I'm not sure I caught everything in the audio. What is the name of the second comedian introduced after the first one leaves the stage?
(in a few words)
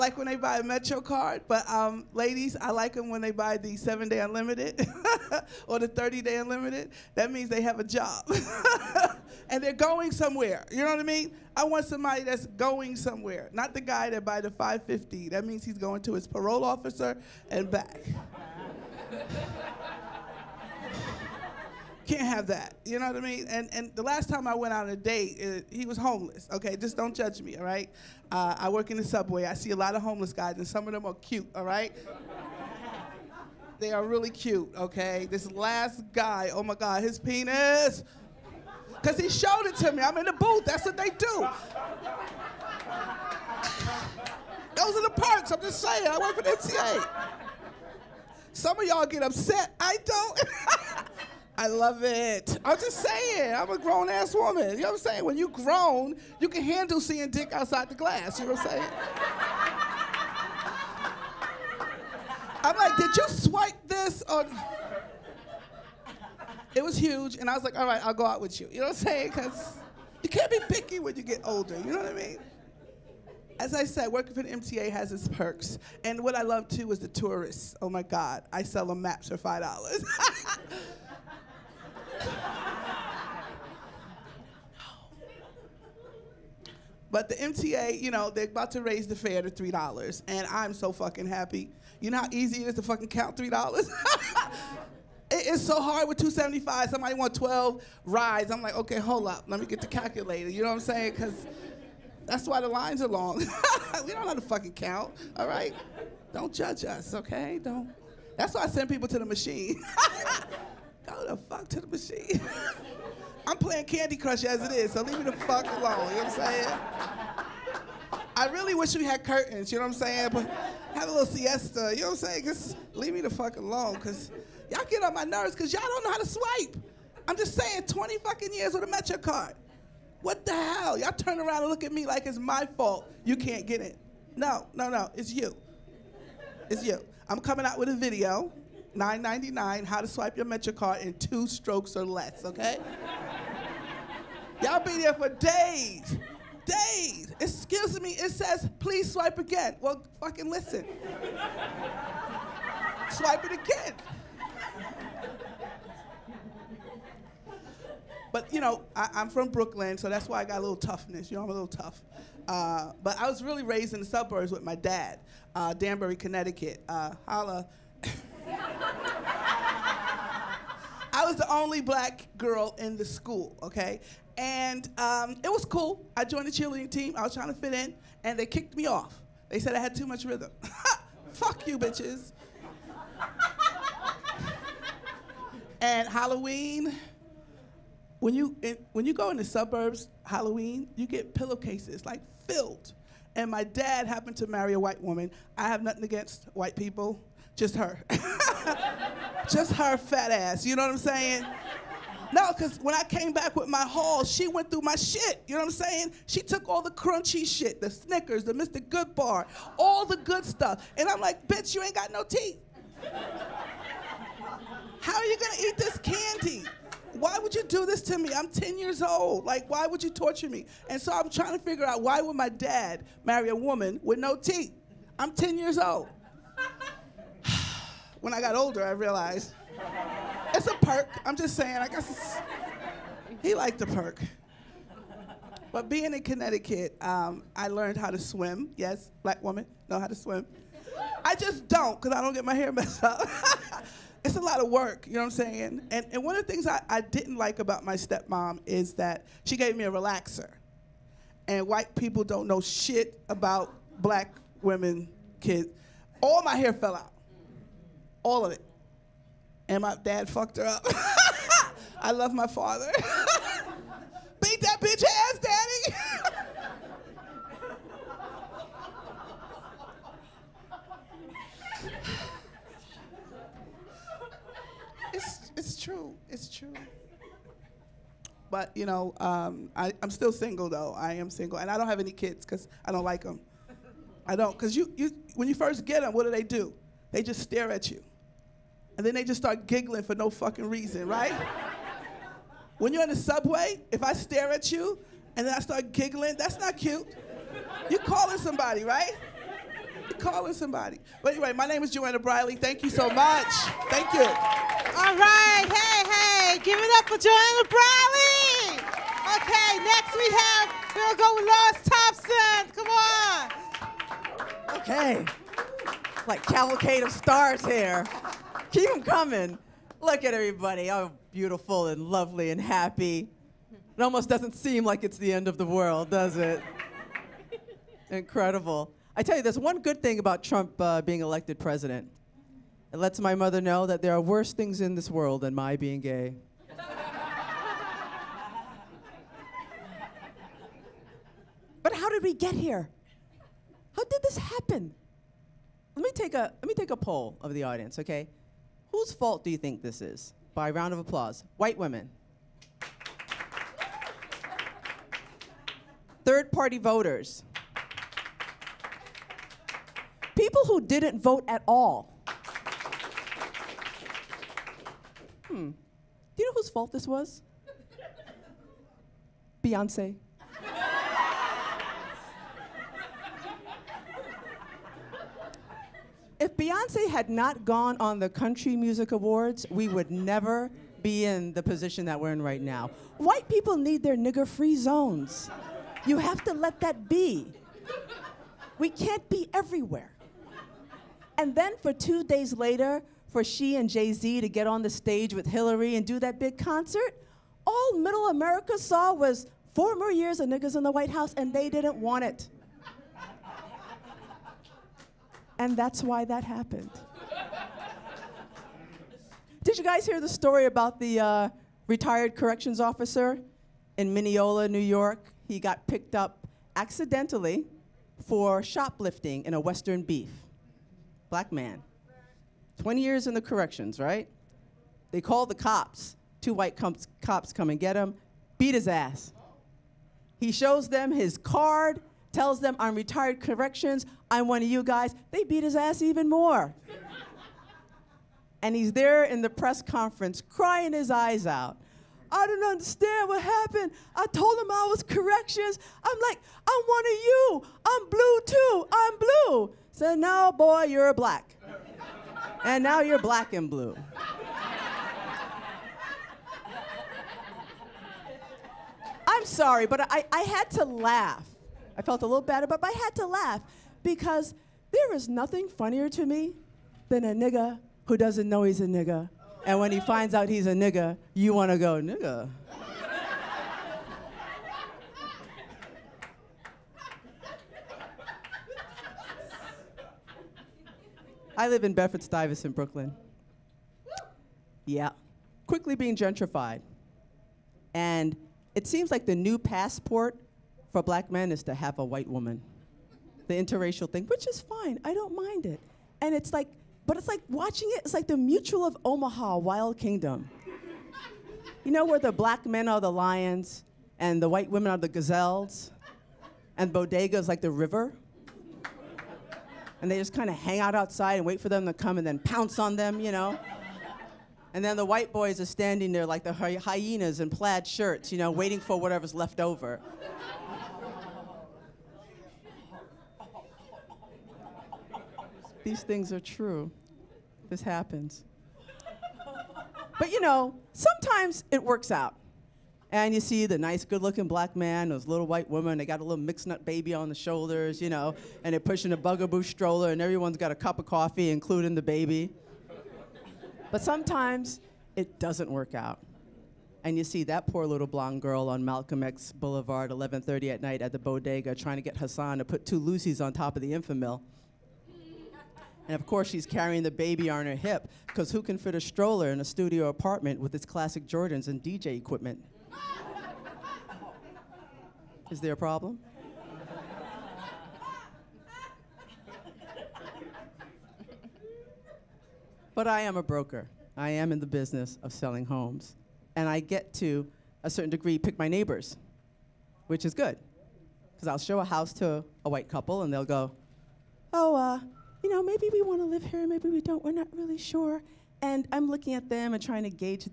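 Lois Thompson.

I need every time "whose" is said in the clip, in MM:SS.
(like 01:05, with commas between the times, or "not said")
05:48, 06:06.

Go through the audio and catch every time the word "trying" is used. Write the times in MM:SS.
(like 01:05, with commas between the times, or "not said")
02:57, 03:41, 09:11, 09:49.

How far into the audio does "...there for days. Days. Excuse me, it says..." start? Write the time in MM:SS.
02:24.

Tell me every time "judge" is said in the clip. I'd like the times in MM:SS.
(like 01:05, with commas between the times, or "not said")
00:27, 01:46.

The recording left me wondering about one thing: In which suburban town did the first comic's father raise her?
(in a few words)
Danbury, Connecticut.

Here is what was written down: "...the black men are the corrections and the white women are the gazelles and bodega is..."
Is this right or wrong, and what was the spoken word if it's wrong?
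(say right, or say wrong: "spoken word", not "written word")
wrong: "lions", not "corrections".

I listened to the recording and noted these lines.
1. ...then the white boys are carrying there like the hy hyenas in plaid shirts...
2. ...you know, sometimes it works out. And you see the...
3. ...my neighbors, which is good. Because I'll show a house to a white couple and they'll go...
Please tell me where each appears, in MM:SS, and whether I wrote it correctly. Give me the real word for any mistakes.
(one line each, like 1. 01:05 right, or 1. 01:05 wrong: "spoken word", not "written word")
1. 08:34 wrong: "standing", not "carrying"
2. 08:50 right
3. 09:38 right.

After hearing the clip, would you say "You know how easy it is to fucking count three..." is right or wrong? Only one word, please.
right.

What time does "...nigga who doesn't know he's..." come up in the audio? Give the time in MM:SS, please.
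07:47.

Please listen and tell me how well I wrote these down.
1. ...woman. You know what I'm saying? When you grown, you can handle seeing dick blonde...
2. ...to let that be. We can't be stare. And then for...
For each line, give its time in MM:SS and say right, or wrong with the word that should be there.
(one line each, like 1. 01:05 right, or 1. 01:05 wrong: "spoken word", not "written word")
1. 00:54 wrong: "outside", not "blonde"
2. 06:26 wrong: "everywhere", not "stare".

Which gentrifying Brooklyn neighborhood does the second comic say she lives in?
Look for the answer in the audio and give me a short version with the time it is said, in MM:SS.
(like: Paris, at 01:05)
Bedford Stuyvesant, at 08:01.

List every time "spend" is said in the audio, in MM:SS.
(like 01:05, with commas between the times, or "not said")
not said.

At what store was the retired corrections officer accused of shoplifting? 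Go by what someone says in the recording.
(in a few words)
Western Beef.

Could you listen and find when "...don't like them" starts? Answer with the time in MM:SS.
04:42.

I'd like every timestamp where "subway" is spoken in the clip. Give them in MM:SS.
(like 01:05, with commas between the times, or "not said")
00:29, 04:53.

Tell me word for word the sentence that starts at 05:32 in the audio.
It lets my mother know that there are worse things in this world than my being gay.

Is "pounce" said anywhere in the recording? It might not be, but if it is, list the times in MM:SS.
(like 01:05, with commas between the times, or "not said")
08:32.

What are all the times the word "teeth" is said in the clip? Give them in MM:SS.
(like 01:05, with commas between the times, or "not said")
03:32, 03:44.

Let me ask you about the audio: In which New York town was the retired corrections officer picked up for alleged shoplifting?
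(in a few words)
Mineola.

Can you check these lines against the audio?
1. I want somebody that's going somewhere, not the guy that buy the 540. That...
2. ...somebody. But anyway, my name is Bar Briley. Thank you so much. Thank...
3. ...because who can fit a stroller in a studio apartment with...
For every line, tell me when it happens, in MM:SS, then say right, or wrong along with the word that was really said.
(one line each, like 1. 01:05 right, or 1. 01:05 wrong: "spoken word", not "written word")
1. 00:11 wrong: "550", not "540"
2. 05:00 wrong: "Joanna", not "Bar"
3. 09:18 right.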